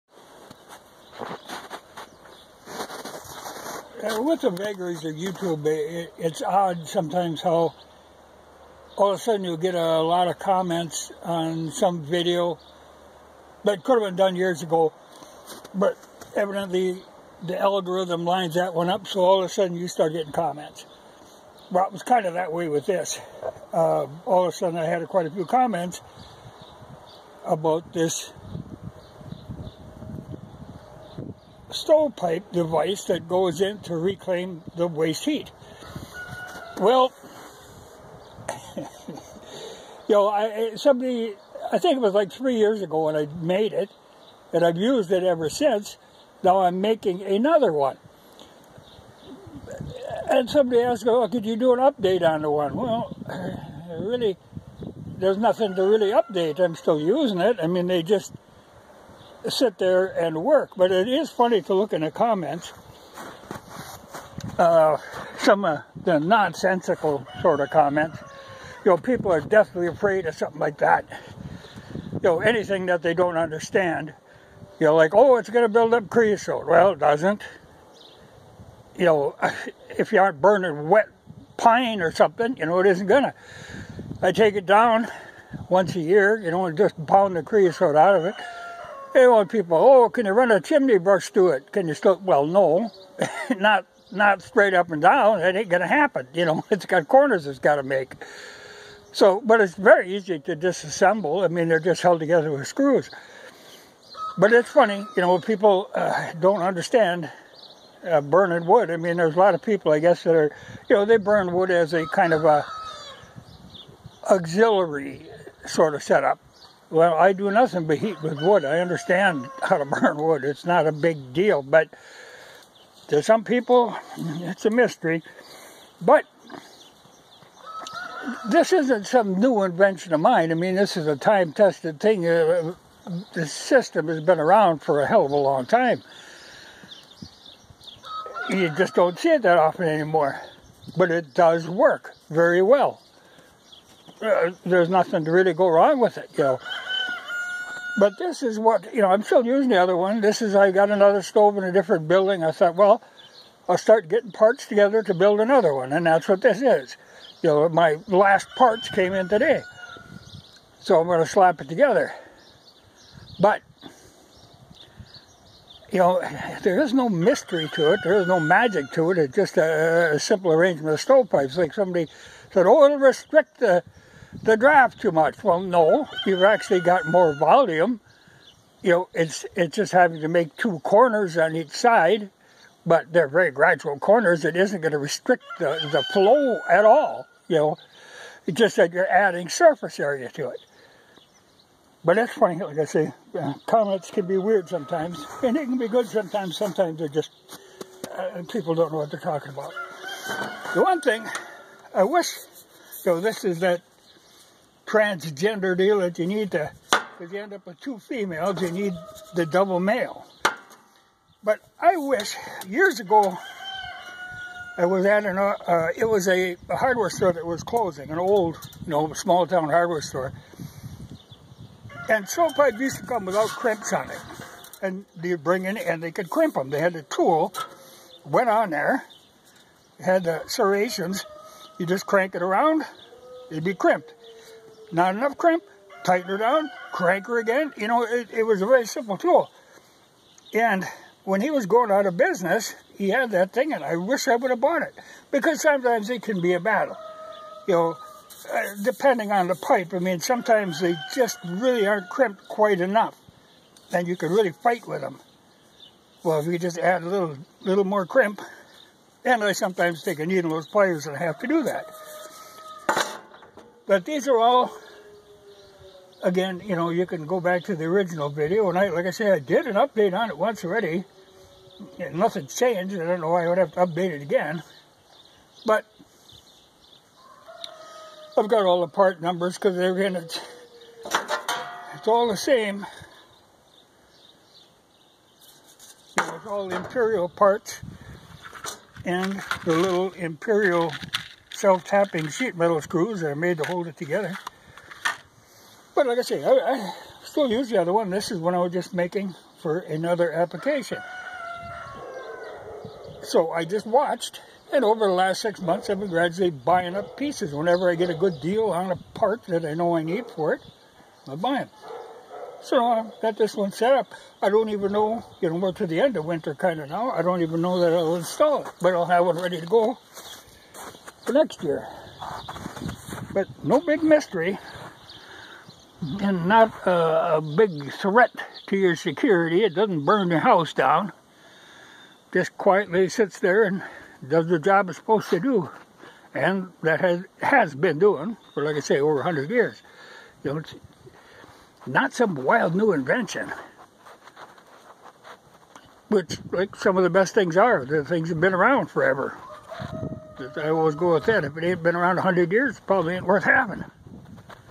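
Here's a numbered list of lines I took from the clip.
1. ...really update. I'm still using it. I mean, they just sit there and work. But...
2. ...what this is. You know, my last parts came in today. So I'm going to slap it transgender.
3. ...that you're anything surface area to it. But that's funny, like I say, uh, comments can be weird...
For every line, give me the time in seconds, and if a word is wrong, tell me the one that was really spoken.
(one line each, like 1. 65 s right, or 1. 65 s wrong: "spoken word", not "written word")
1. 55 s right
2. 156 s wrong: "together", not "transgender"
3. 188 s wrong: "adding", not "anything".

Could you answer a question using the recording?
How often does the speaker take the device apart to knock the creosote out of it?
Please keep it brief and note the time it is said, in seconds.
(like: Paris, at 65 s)
Once a year, at 85 s.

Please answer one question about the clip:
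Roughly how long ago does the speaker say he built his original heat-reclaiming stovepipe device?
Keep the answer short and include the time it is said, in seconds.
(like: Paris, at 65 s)
3 years ago, at 42 s.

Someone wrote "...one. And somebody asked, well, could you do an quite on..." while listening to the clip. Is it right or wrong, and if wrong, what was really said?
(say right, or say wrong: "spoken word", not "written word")
wrong: "update", not "quite".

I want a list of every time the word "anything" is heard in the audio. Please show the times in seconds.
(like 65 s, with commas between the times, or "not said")
72 s.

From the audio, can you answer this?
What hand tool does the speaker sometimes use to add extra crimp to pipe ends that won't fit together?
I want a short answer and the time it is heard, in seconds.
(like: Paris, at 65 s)
Needle nose pliers, at 260 s.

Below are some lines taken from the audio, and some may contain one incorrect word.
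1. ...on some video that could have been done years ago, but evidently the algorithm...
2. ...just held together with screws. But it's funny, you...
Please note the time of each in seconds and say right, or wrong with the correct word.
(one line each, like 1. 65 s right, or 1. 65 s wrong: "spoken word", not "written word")
1. 11 s right
2. 101 s right.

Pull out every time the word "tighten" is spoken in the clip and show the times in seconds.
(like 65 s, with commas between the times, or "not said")
236 s.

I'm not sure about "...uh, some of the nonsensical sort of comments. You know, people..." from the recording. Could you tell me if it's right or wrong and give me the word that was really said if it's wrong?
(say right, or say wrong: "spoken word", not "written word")
right.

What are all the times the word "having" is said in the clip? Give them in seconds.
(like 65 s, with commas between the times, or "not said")
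179 s, 353 s.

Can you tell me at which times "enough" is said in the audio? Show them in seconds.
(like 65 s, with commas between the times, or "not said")
235 s, 252 s.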